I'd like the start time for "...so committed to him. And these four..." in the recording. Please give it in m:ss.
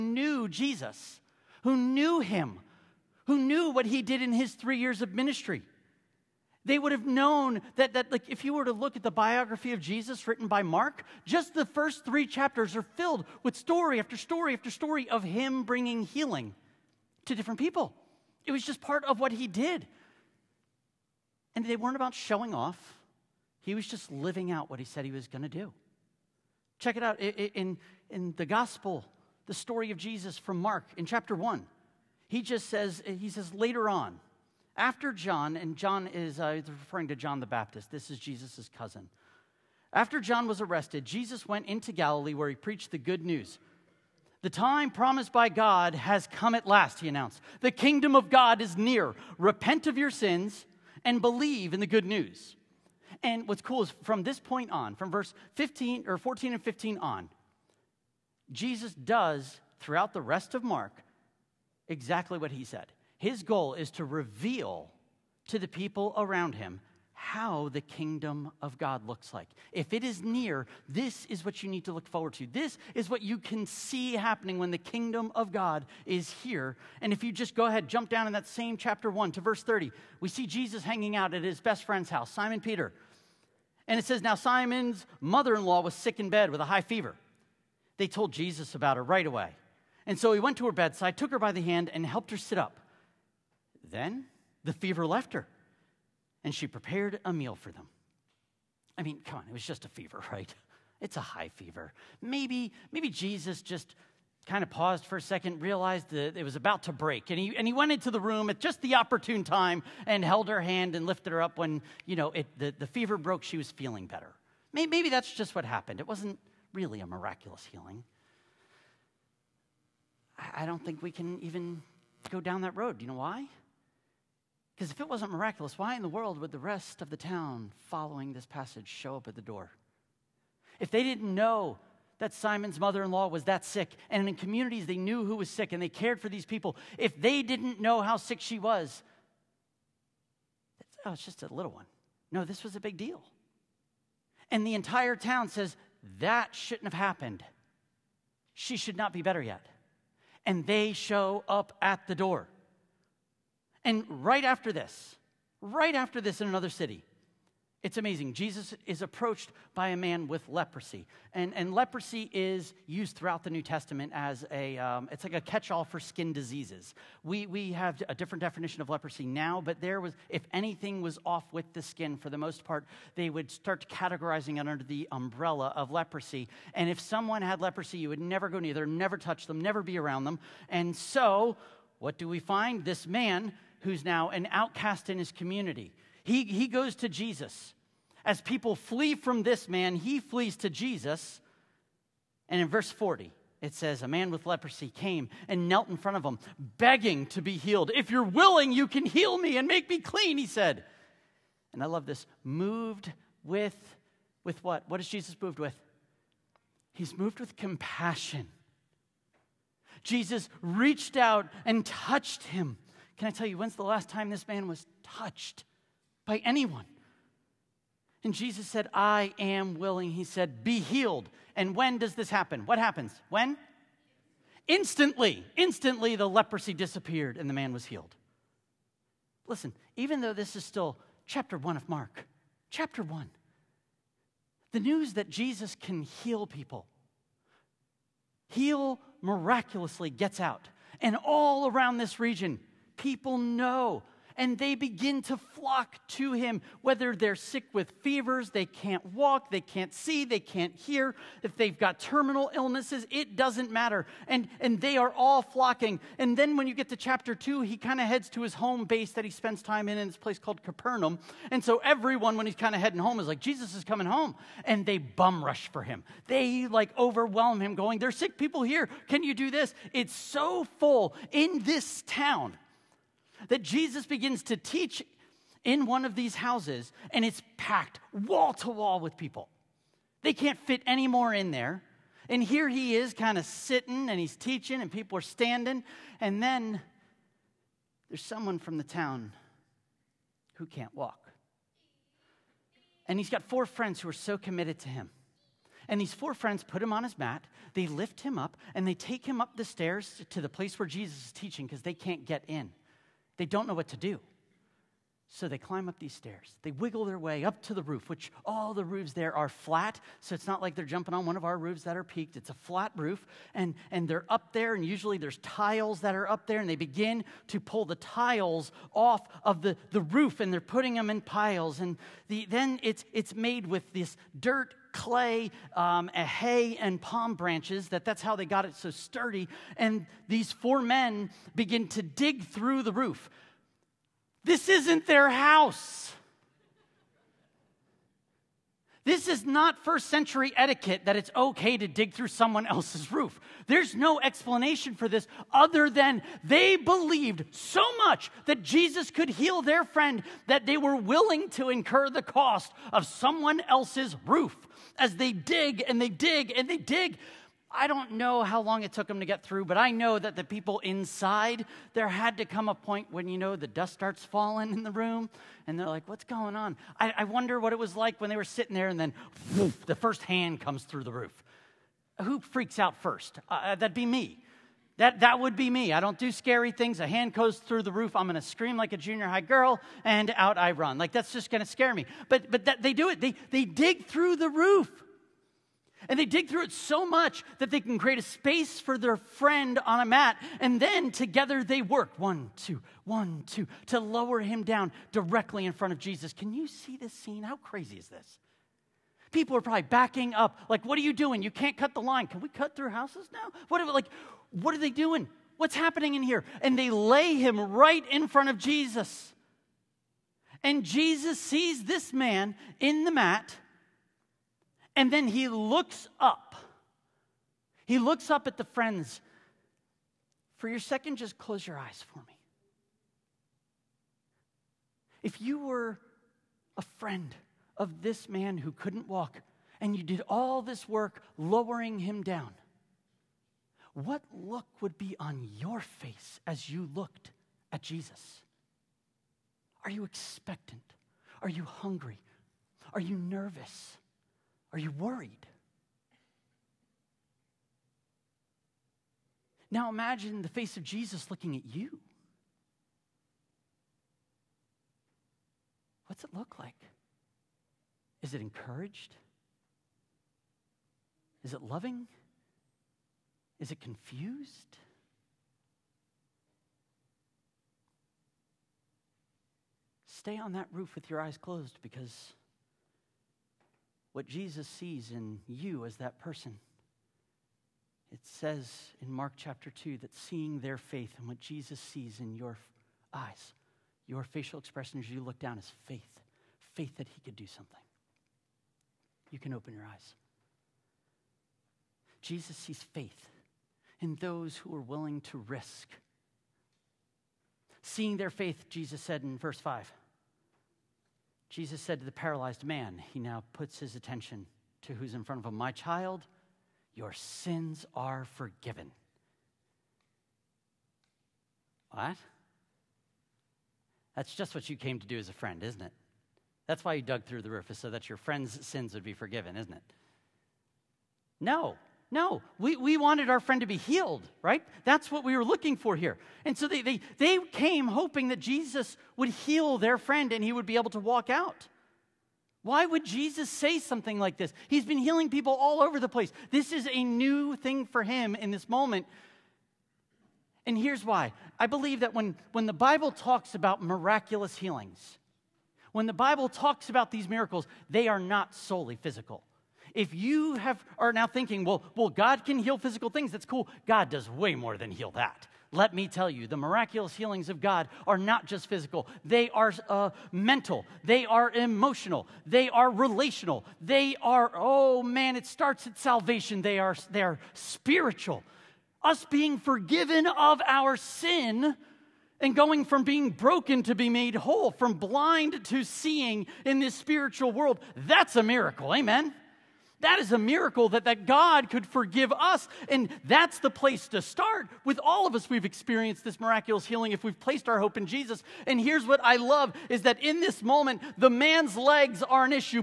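4:54.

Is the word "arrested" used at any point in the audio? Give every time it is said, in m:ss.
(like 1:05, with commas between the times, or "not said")
0:40.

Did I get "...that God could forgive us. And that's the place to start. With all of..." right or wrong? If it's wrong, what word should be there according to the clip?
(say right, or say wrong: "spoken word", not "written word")
right.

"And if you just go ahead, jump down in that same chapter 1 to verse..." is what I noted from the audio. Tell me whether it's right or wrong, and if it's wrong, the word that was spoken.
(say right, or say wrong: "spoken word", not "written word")
right.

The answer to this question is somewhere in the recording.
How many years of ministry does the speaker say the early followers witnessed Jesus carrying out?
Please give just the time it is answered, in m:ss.
0:04.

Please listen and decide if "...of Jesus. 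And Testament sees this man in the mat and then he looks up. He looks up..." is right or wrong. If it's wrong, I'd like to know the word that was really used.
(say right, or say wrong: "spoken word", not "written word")
wrong: "Jesus", not "Testament".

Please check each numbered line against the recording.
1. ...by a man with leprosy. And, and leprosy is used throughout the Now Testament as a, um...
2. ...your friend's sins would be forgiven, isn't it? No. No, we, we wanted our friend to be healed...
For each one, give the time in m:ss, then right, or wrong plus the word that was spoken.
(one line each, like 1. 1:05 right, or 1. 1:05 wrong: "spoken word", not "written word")
1. 2:39 wrong: "New", not "Now"
2. 8:38 right.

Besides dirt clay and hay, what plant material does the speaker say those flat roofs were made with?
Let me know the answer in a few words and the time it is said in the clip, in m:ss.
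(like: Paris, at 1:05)
palm branches, at 5:27.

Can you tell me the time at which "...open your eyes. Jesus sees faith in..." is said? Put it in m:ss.
8:09.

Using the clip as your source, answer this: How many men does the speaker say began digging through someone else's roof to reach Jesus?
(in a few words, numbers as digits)
4.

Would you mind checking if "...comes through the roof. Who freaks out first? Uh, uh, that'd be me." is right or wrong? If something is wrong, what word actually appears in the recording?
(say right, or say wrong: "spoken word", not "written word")
right.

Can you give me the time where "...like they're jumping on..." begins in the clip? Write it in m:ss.
5:10.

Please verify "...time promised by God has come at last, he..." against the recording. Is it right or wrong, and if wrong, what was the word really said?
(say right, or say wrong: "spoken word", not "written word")
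right.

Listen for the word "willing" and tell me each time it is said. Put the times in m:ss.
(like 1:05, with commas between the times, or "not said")
3:18, 3:39, 5:50, 8:14.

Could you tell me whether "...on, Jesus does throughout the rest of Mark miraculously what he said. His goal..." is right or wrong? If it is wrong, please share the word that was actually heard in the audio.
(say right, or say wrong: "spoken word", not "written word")
wrong: "exactly", not "miraculously".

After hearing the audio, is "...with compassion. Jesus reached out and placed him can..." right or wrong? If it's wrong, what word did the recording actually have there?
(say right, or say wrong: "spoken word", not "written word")
wrong: "touched", not "placed".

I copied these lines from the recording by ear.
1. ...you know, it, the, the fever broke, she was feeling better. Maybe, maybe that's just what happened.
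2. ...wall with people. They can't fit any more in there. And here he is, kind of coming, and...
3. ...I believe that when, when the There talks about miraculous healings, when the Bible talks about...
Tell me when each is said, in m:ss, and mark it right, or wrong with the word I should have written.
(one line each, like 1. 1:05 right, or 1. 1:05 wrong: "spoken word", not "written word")
1. 1:52 right
2. 4:38 wrong: "sitting", not "coming"
3. 9:01 wrong: "Bible", not "There".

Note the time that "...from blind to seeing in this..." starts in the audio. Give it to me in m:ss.
9:34.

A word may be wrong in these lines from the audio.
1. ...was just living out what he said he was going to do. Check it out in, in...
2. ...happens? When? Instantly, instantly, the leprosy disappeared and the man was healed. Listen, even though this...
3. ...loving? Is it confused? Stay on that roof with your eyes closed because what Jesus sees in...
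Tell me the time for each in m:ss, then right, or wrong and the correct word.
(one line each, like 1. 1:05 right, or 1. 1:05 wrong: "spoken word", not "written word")
1. 0:23 right
2. 3:42 right
3. 7:41 right.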